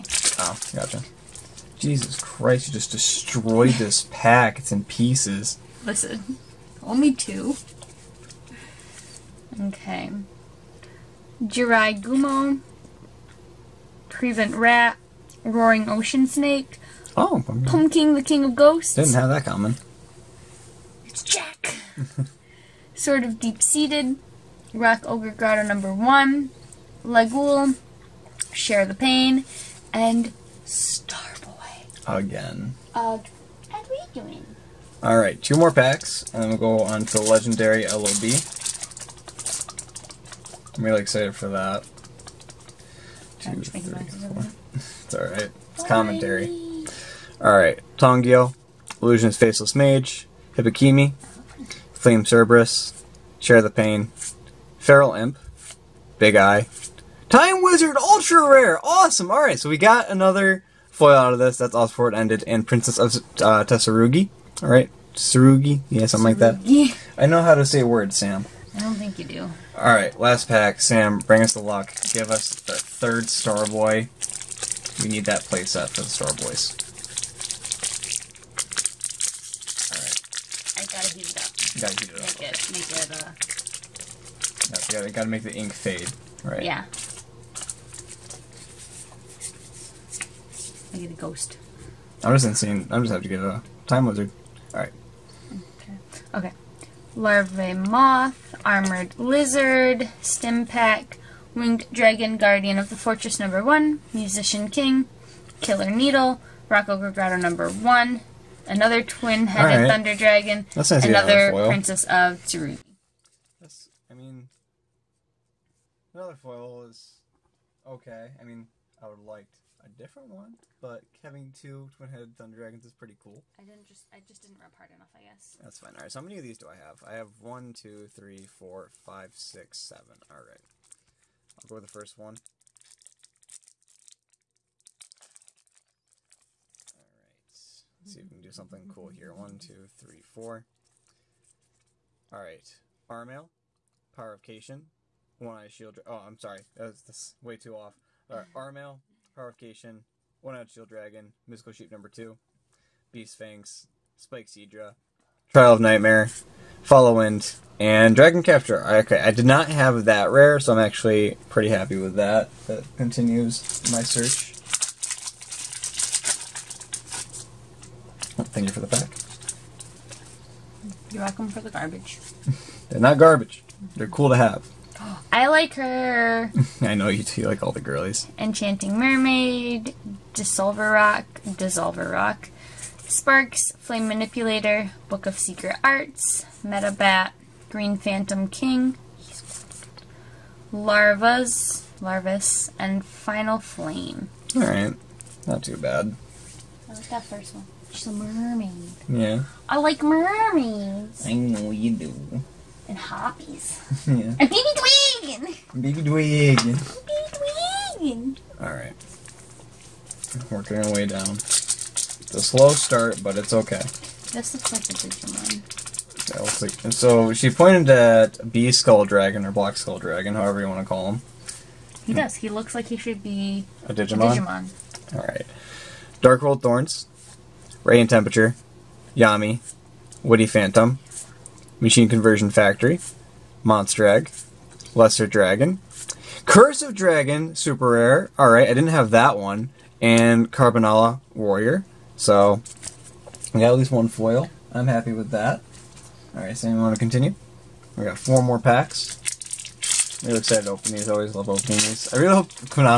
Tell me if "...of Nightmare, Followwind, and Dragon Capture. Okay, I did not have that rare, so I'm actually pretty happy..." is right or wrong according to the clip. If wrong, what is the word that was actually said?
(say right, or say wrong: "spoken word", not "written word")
right.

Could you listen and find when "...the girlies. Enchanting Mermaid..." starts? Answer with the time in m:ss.
2:57.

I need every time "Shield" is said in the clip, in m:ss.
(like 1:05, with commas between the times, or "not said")
2:25, 2:30.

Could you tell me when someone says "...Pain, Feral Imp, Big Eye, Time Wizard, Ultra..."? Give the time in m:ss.
0:53.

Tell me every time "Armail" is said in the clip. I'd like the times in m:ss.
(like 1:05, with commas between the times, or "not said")
2:23, 2:28.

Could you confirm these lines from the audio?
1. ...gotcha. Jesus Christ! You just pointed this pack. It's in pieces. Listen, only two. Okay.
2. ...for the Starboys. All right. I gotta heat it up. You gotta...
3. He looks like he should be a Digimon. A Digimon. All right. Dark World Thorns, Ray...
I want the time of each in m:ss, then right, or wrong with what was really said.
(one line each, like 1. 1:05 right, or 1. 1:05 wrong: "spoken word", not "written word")
1. 0:00 wrong: "destroyed", not "pointed"
2. 1:15 right
3. 3:42 right.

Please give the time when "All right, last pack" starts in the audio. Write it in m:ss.
1:09.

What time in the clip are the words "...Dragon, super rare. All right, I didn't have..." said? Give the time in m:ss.
3:56.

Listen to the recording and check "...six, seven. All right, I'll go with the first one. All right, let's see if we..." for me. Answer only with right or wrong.
right.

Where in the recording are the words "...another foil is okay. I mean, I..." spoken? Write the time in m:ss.
1:56.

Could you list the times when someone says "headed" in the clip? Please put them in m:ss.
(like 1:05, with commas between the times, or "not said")
1:49, 2:01.